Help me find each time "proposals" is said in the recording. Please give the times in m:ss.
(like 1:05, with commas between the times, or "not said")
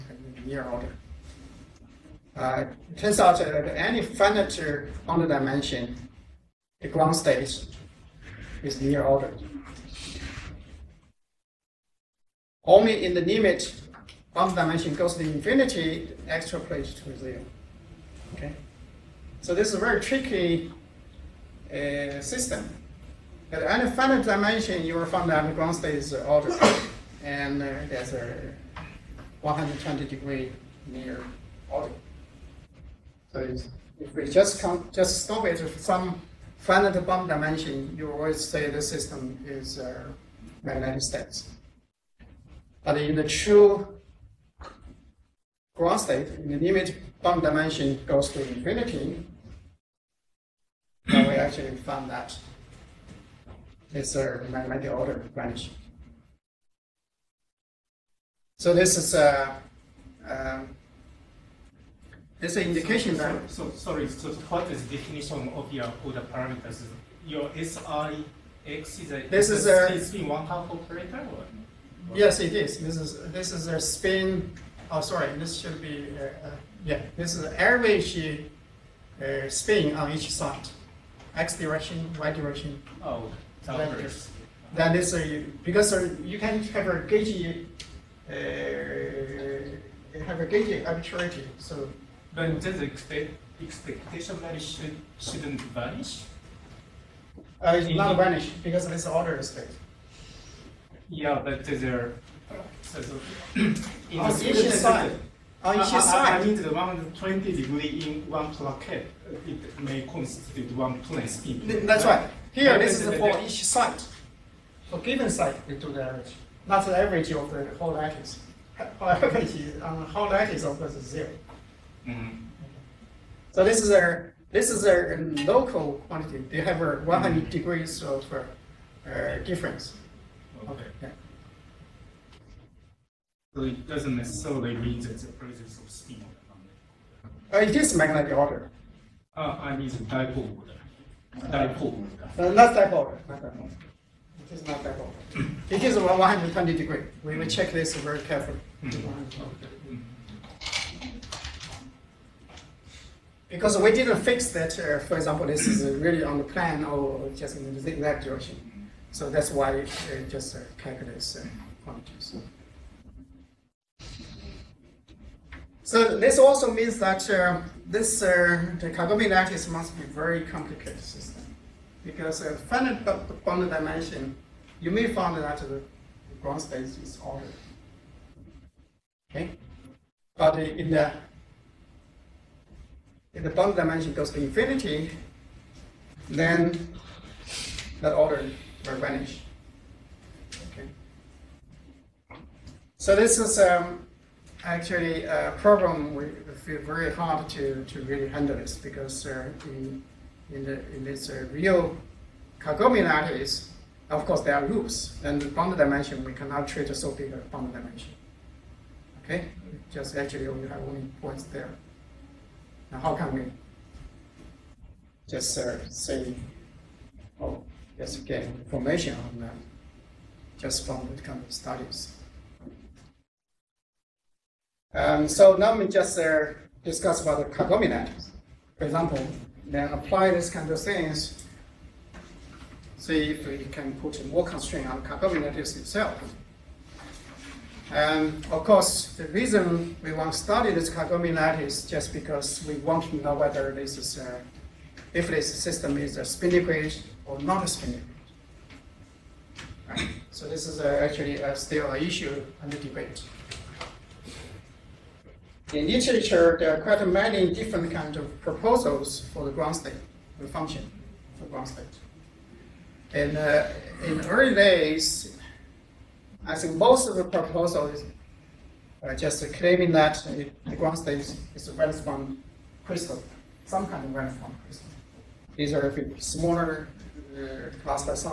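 4:18, 4:27.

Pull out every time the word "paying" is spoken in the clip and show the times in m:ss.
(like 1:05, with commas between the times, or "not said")
not said.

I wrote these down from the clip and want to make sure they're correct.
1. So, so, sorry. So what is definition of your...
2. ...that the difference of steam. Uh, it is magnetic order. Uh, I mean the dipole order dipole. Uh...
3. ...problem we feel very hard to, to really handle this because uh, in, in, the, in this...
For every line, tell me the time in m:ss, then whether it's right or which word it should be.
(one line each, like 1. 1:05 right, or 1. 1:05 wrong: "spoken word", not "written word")
1. 1:03 right
2. 2:15 wrong: "presence", not "difference"
3. 3:15 right.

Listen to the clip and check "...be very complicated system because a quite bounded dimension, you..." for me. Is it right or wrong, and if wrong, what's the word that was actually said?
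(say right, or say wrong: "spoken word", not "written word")
wrong: "finite", not "quite".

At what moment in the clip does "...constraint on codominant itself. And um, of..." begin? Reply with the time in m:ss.
3:54.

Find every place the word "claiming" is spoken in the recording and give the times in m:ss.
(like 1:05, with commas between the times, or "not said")
4:29.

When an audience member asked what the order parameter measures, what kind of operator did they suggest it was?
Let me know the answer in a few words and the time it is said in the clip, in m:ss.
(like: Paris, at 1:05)
spin one half operator, at 1:09.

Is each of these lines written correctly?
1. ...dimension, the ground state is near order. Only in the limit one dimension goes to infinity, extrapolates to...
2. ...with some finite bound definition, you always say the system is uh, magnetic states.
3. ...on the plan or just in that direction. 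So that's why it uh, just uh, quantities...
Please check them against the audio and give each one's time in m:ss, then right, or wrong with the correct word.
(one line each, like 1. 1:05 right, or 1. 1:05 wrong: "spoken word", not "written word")
1. 0:05 right
2. 0:35 wrong: "dimension", not "definition"
3. 2:36 wrong: "calculates", not "quantities".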